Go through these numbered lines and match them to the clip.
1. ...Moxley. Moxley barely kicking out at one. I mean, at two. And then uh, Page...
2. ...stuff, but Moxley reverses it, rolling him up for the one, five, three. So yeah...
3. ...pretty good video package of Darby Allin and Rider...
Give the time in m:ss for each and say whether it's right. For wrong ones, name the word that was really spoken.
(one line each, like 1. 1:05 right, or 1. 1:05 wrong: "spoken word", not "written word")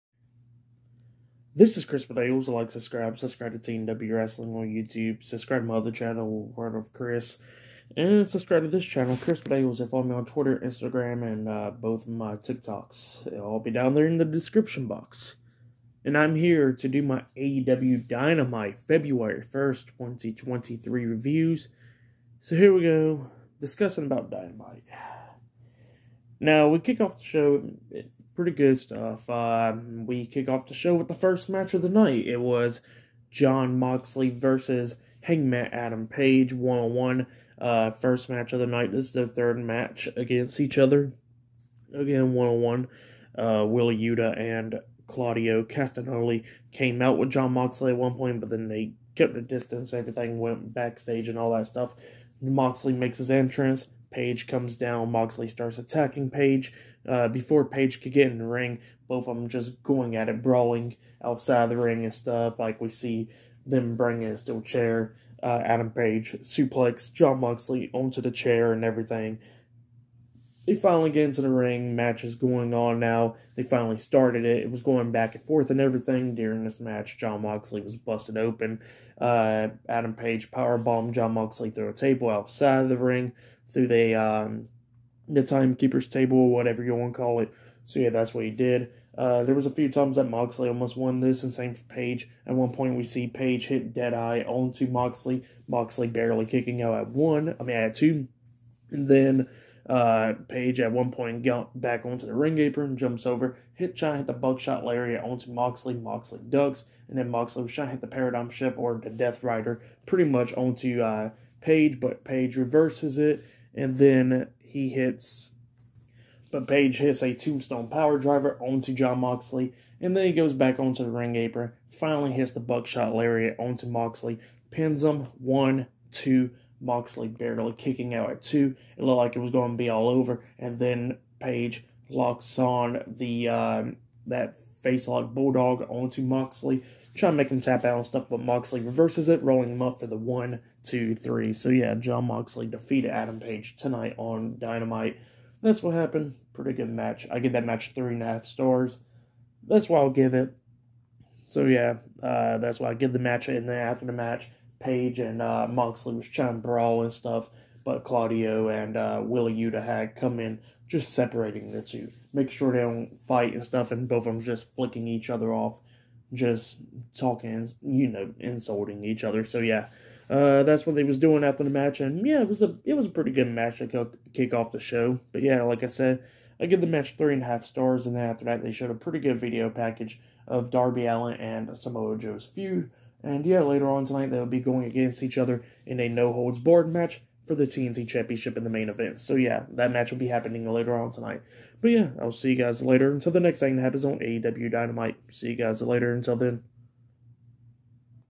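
1. 1:34 right
2. 2:18 wrong: "two", not "five"
3. 2:58 wrong: "Samoa", not "Rider".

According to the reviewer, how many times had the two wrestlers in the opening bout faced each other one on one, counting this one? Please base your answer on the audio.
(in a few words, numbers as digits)
3.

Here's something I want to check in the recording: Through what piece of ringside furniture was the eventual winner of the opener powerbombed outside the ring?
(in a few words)
Timekeeper's table.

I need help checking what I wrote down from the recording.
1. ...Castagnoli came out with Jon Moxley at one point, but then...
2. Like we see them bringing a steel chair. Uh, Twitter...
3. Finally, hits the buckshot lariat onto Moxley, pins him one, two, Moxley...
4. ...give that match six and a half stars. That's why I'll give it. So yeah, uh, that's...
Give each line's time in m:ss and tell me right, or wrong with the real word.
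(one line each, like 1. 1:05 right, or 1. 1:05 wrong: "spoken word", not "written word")
1. 0:45 right
2. 1:02 wrong: "Adam", not "Twitter"
3. 2:01 right
4. 2:27 wrong: "three", not "six".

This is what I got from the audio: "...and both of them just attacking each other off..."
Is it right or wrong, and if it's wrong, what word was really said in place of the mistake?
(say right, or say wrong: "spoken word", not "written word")
wrong: "flicking", not "attacking".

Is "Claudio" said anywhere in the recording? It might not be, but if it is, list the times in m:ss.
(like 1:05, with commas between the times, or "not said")
0:45, 2:38.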